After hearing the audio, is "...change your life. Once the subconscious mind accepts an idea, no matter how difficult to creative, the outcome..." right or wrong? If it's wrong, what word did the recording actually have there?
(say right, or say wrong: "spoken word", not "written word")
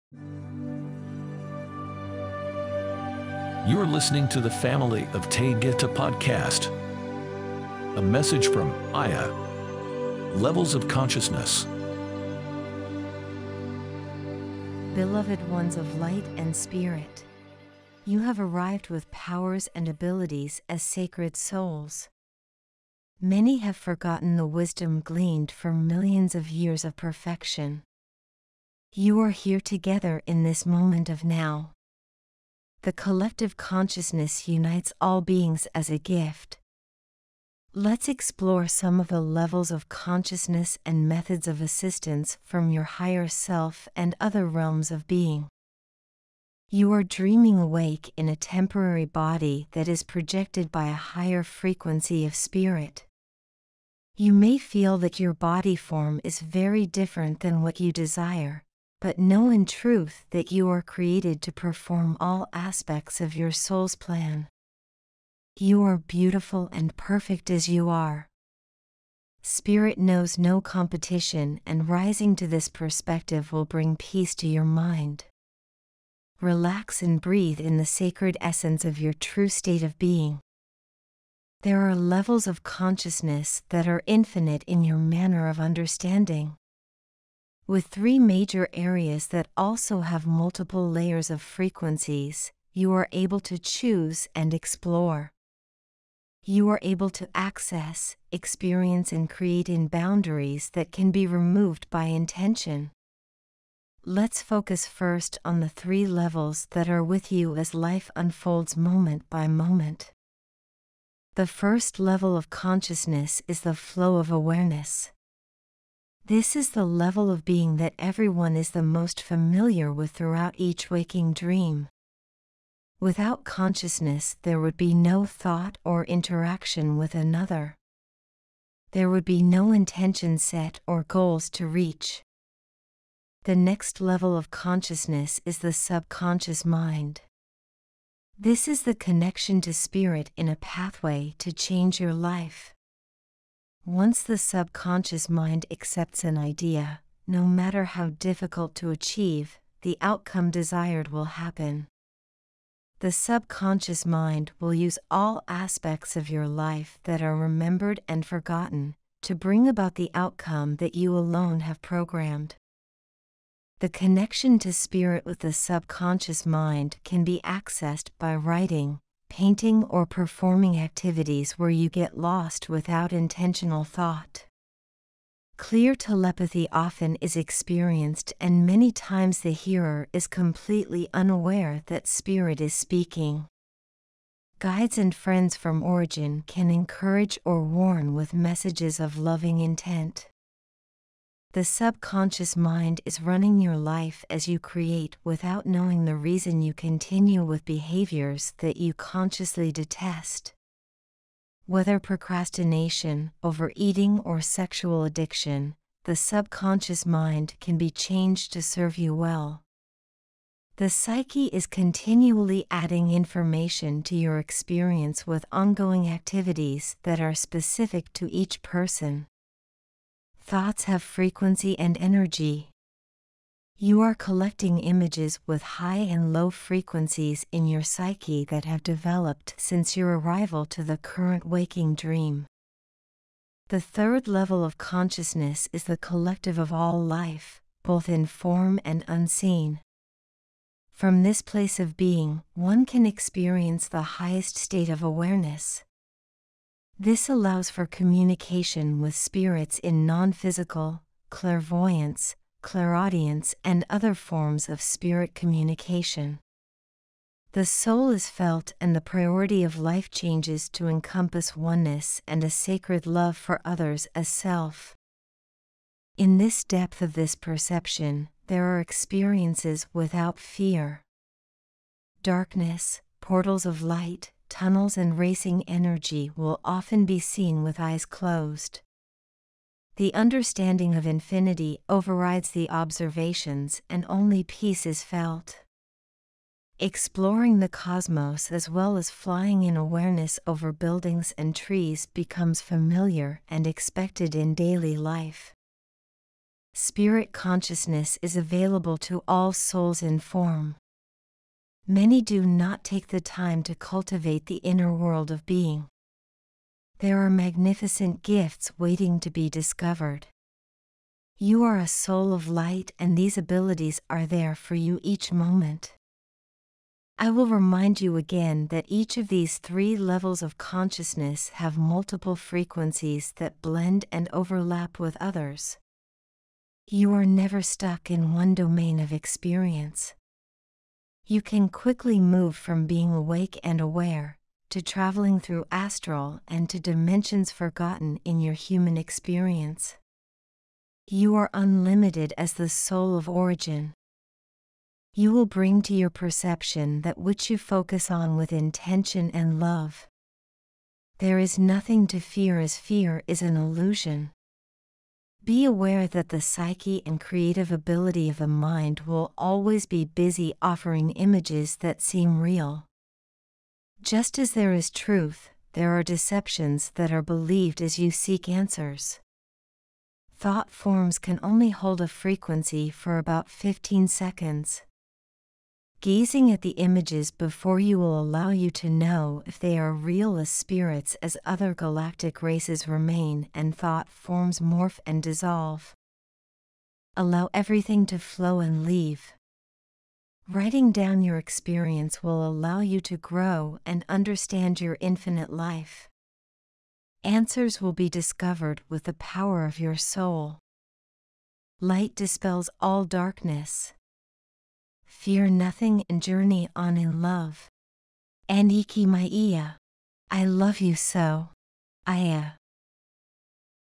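wrong: "achieve", not "creative".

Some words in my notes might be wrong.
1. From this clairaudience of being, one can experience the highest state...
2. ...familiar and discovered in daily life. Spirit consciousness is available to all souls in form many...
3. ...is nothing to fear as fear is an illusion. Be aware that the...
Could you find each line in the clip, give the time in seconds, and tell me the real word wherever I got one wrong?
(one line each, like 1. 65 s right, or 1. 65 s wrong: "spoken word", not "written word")
1. 240 s wrong: "place", not "clairaudience"
2. 292 s wrong: "expected", not "discovered"
3. 351 s right.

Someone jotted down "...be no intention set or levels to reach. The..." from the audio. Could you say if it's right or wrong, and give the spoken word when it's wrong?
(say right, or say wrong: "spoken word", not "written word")
wrong: "goals", not "levels".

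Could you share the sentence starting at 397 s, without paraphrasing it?
Answers will be discovered with the power of your soul.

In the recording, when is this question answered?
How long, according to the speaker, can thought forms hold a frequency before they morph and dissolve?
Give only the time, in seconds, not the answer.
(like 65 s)
373 s.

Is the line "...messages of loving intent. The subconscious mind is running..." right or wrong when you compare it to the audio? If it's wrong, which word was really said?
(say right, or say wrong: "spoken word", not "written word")
right.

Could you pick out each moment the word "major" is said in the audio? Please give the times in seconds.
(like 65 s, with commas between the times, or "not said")
88 s.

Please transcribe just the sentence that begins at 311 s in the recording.
You are a soul of light, and these abilities are there for you each moment.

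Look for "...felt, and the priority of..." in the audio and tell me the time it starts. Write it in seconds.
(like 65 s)
258 s.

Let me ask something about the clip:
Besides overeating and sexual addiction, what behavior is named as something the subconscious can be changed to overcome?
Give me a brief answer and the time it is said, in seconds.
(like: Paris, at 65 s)
procrastination, at 201 s.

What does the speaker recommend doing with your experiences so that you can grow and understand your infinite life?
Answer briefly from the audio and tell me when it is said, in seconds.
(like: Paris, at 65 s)
Writing down, at 390 s.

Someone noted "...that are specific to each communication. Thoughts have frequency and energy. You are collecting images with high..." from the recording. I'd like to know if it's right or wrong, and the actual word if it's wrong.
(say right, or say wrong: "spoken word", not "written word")
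wrong: "person", not "communication".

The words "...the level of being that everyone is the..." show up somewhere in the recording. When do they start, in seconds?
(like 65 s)
116 s.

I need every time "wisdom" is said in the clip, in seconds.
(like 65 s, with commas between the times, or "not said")
24 s.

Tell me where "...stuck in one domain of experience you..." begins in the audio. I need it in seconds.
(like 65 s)
327 s.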